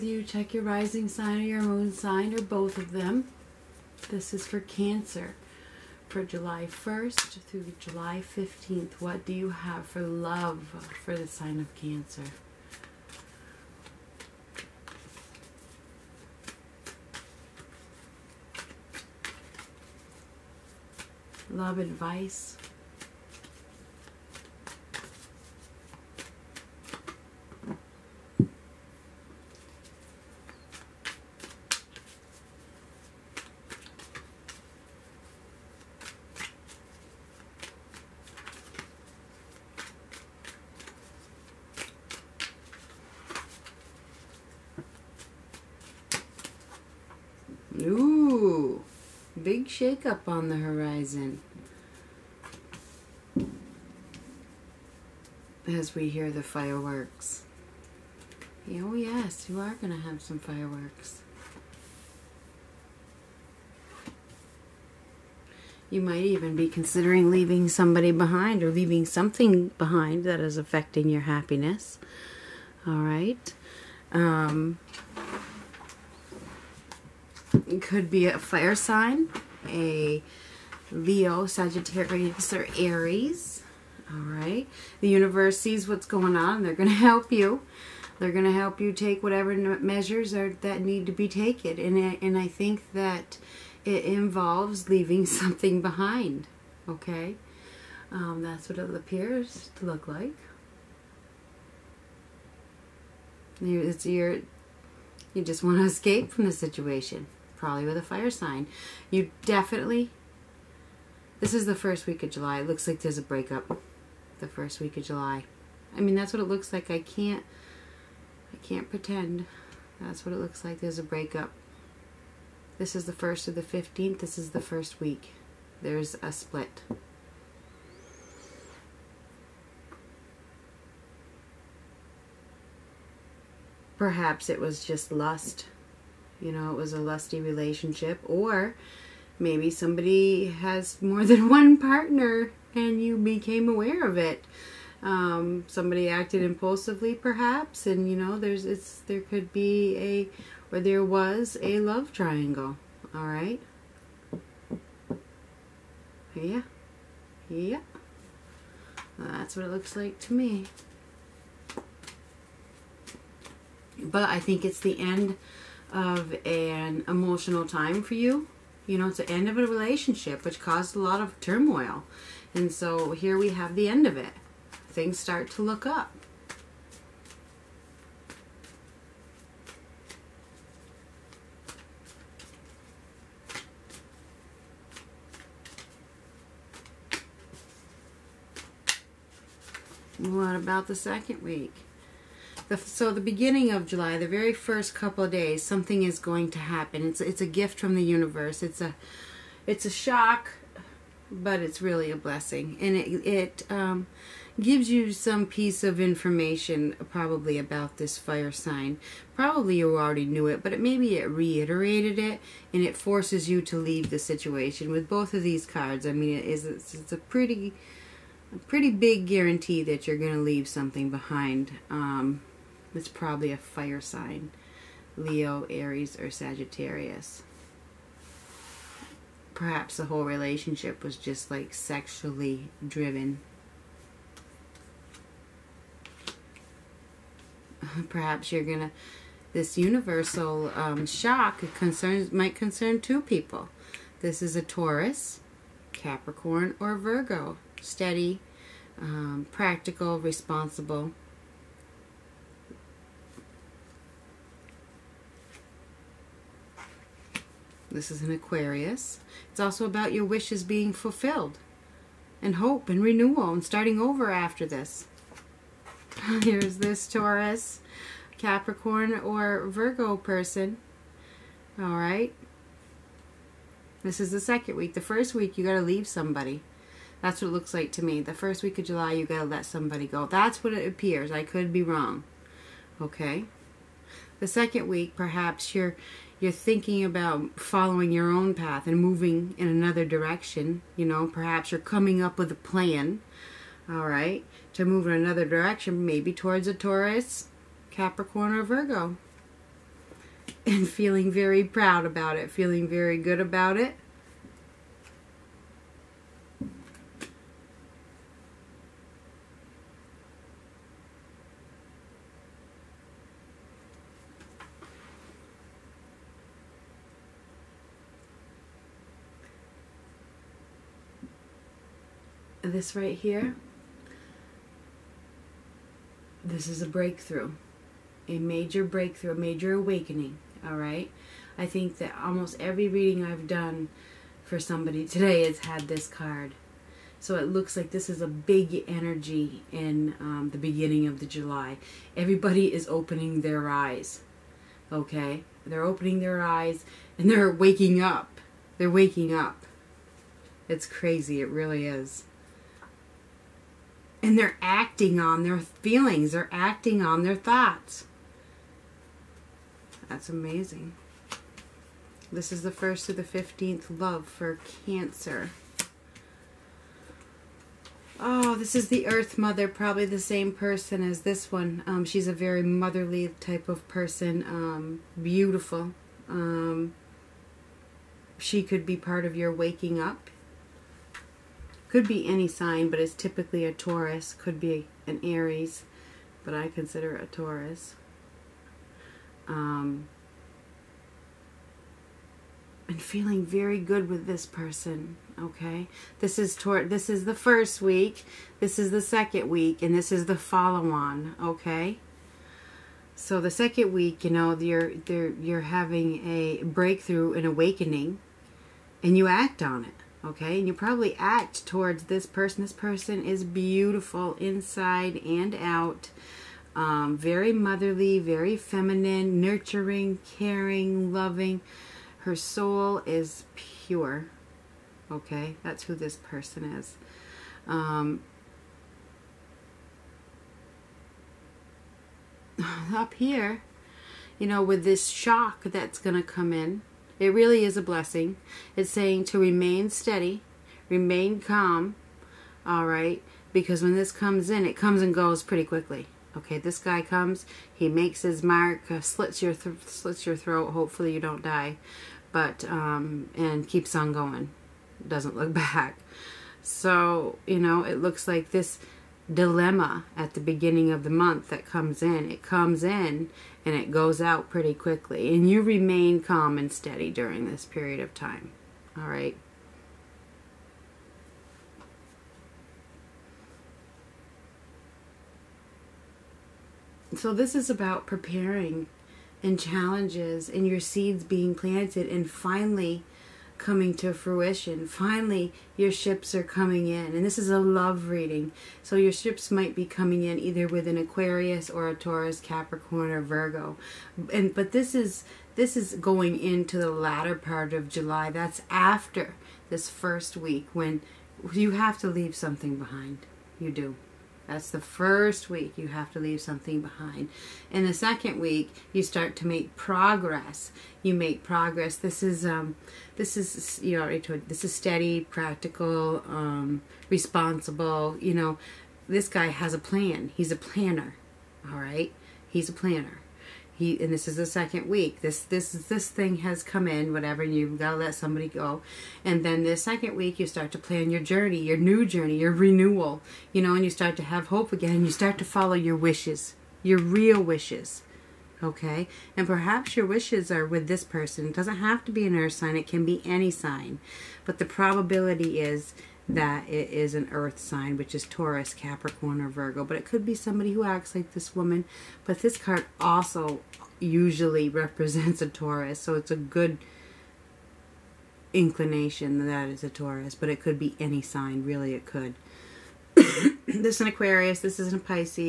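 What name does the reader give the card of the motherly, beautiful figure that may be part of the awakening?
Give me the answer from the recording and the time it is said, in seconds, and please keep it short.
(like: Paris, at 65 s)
The Earth Mother, at 369 s.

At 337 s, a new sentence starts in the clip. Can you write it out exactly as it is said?
So it looks like this is a big energy in um, the beginning of the July.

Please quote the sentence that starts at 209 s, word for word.
Probably you already knew it, but it, maybe it reiterated it, and it forces you to leave the situation.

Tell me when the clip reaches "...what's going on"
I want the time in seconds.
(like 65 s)
85 s.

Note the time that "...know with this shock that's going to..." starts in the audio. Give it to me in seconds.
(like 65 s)
434 s.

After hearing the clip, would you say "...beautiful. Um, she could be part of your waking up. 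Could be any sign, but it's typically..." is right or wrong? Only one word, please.
right.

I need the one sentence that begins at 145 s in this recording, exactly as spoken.
Um, somebody acted impulsively, perhaps, and you know, there's it's there could be a or there was a love triangle.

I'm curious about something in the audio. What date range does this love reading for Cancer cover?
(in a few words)
July 1st through July 15th.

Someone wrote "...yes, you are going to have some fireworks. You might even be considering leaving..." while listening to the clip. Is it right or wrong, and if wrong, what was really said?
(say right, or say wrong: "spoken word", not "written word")
right.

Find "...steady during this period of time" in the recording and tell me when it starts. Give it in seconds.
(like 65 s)
466 s.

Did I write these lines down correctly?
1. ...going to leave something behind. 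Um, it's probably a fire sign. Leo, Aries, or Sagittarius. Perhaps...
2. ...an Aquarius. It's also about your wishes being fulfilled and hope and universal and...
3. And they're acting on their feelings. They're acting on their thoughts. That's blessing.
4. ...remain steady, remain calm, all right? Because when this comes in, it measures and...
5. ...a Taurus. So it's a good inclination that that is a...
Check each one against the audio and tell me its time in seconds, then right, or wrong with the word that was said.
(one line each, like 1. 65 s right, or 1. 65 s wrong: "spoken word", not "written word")
1. 220 s right
2. 258 s wrong: "renewal", not "universal"
3. 354 s wrong: "amazing", not "blessing"
4. 439 s wrong: "comes", not "measures"
5. 555 s right.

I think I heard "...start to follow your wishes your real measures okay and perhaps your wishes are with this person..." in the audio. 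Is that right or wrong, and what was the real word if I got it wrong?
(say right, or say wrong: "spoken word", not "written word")
wrong: "wishes", not "measures".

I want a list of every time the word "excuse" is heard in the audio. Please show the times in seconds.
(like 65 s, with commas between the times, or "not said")
not said.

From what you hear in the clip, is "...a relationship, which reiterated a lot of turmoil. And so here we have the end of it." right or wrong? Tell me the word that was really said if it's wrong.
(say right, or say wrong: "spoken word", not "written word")
wrong: "caused", not "reiterated".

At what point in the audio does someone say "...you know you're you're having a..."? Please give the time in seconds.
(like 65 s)
404 s.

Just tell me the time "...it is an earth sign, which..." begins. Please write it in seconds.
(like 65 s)
546 s.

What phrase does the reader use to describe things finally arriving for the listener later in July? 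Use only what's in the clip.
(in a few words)
Ships are coming in.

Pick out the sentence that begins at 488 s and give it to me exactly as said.
So your ships might be coming in either with an Aquarius or a Taurus, Capricorn or Virgo.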